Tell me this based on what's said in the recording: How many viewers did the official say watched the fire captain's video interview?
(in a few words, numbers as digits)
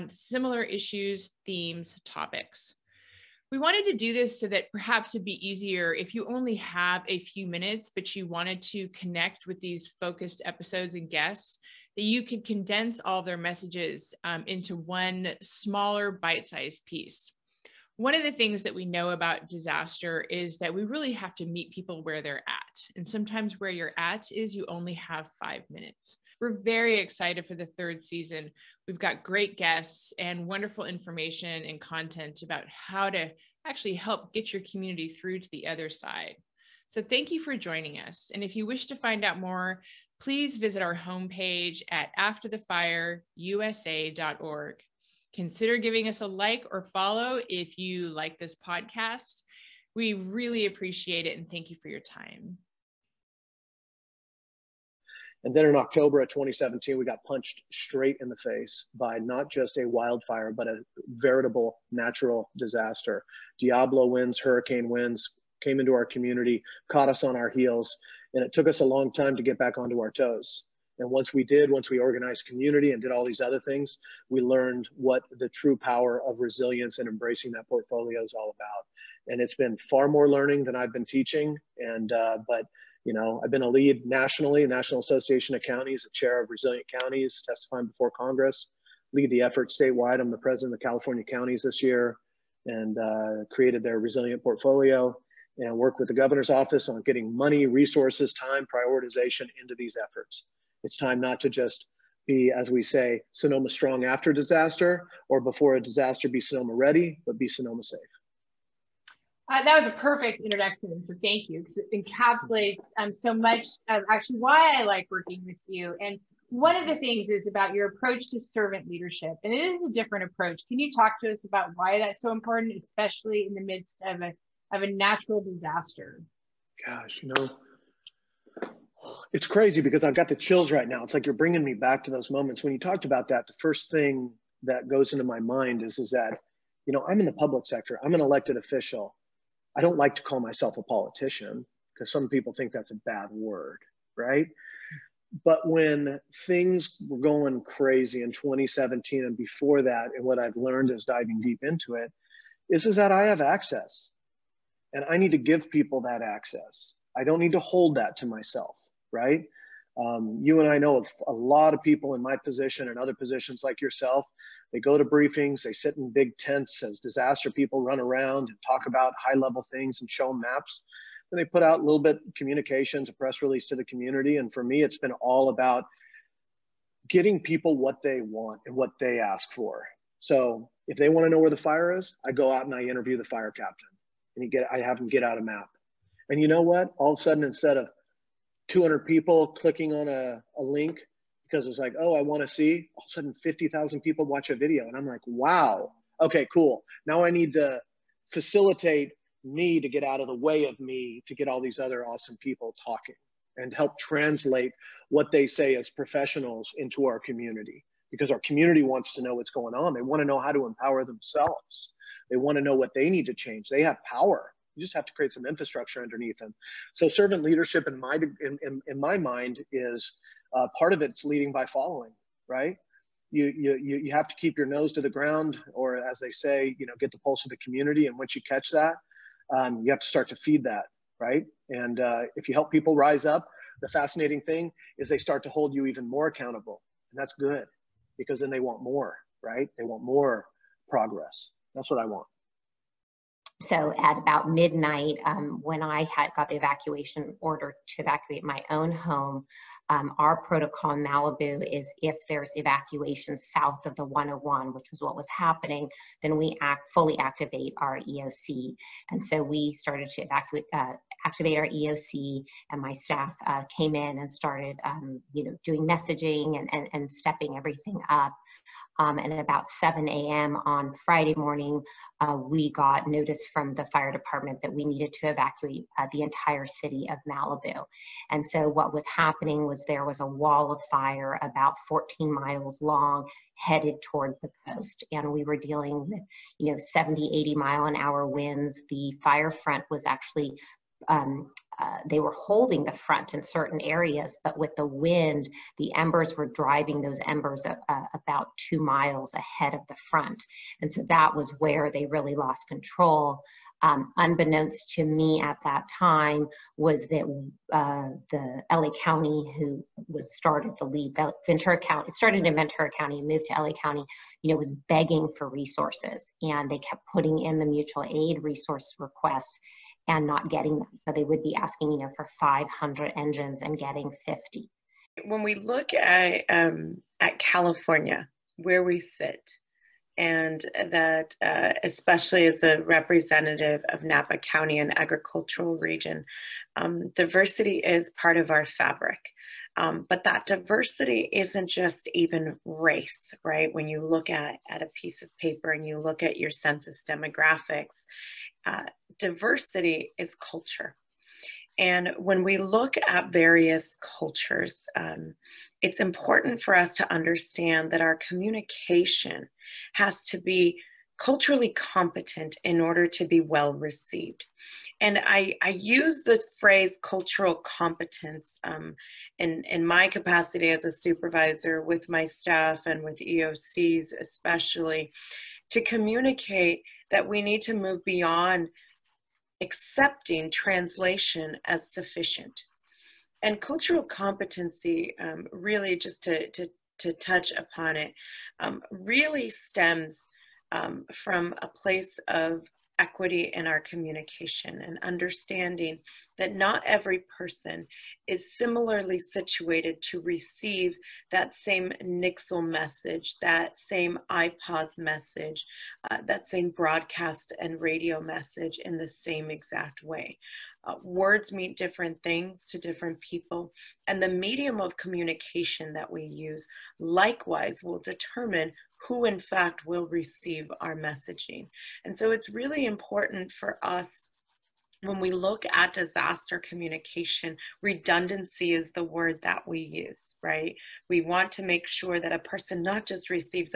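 50,000.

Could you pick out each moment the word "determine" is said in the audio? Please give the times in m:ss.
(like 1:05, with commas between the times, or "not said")
6:57.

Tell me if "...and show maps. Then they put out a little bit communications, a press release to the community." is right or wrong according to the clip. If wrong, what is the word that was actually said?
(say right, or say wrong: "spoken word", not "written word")
right.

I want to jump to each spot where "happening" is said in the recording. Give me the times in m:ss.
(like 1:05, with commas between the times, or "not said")
4:15, 4:39.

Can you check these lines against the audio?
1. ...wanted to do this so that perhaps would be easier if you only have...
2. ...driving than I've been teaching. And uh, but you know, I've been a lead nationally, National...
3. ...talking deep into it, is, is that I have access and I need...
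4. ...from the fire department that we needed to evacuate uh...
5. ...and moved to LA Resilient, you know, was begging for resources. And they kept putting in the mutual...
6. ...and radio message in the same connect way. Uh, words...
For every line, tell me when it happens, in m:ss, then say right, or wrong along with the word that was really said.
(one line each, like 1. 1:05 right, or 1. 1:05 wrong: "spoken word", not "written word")
1. 0:03 right
2. 1:20 wrong: "learning", not "driving"
3. 2:31 wrong: "diving", not "talking"
4. 4:33 right
5. 5:13 wrong: "County", not "Resilient"
6. 6:47 wrong: "exact", not "connect".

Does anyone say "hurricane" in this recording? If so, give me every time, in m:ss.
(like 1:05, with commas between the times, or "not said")
1:04.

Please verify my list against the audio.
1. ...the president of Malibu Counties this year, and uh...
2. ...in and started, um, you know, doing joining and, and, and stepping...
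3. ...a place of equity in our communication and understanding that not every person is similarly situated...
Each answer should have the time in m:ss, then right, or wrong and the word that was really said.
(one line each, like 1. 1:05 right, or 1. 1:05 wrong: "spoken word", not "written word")
1. 1:30 wrong: "California", not "Malibu"
2. 4:23 wrong: "messaging", not "joining"
3. 6:31 right.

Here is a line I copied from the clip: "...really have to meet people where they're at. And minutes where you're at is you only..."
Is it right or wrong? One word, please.
wrong.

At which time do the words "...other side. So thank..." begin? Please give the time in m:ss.
0:35.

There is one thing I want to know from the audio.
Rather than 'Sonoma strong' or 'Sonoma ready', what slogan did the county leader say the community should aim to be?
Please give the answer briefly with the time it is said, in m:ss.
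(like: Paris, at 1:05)
Sonoma safe, at 1:47.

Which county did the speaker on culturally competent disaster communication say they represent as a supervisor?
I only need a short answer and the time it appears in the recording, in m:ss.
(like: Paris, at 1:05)
Napa County, at 5:34.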